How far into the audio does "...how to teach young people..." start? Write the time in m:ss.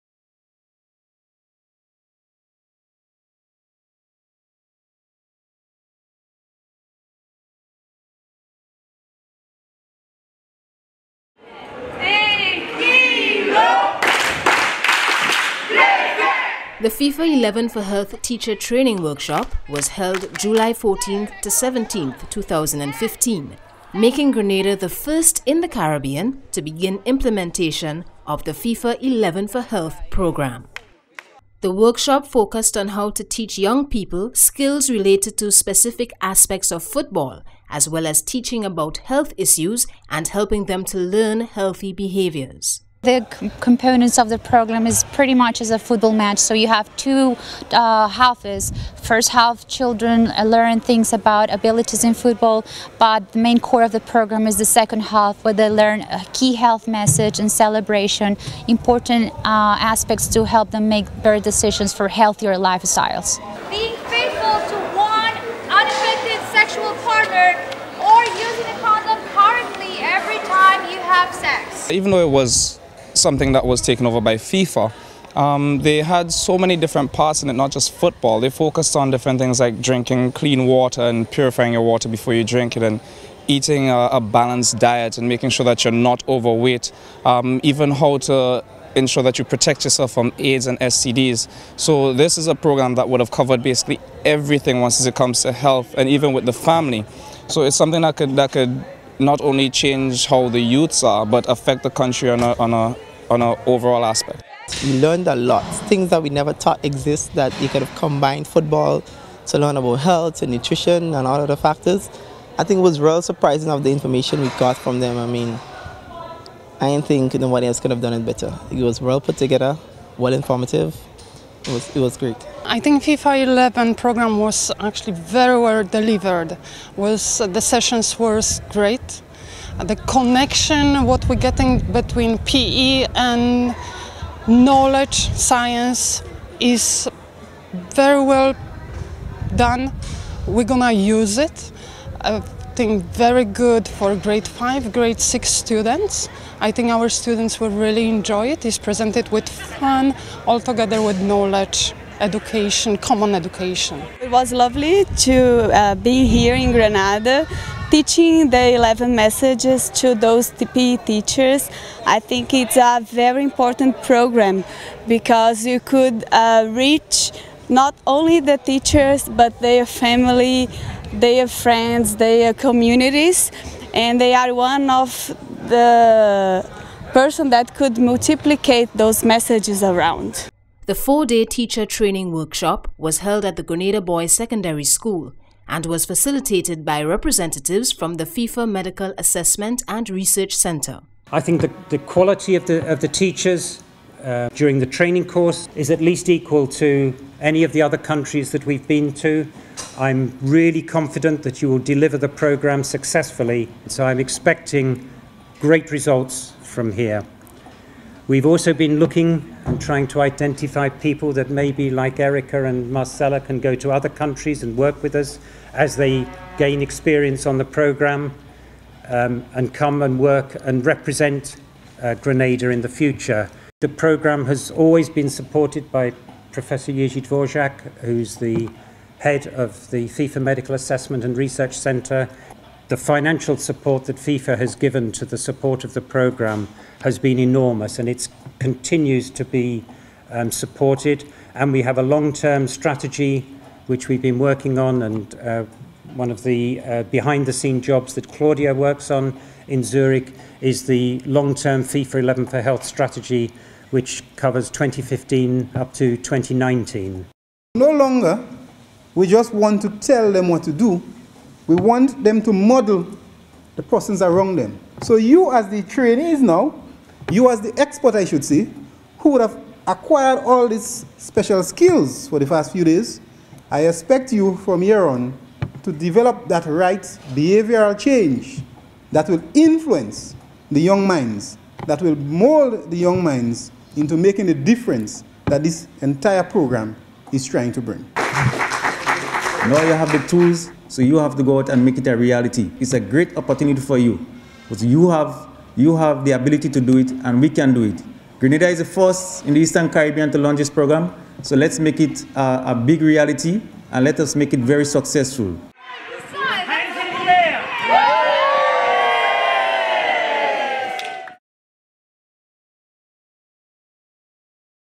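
0:32.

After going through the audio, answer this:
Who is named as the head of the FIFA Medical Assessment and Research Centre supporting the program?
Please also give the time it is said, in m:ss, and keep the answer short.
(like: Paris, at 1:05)
Jerzy Dvorak, at 3:46.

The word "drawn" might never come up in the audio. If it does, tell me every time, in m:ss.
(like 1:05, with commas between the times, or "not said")
not said.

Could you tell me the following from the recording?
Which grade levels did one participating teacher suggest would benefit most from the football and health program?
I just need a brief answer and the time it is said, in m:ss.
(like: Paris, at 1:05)
Grade five, grade six, at 2:24.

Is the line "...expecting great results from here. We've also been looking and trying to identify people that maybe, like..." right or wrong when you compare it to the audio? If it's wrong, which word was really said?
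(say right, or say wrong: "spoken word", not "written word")
right.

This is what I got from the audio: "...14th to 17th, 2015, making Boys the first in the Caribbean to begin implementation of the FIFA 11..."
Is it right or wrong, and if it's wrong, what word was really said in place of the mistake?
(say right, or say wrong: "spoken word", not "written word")
wrong: "Grenada", not "Boys".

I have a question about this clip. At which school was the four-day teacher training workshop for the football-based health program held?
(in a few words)
Grenada Boys Secondary School.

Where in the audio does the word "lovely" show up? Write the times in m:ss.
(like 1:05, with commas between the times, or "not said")
2:34.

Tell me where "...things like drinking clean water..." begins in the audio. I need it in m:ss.
1:19.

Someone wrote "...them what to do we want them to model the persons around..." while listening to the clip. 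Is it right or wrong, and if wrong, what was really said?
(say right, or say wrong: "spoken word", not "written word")
right.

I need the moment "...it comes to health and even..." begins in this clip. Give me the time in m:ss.
1:35.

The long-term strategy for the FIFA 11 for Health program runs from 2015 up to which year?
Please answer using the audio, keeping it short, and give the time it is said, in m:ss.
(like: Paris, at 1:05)
2019, at 4:16.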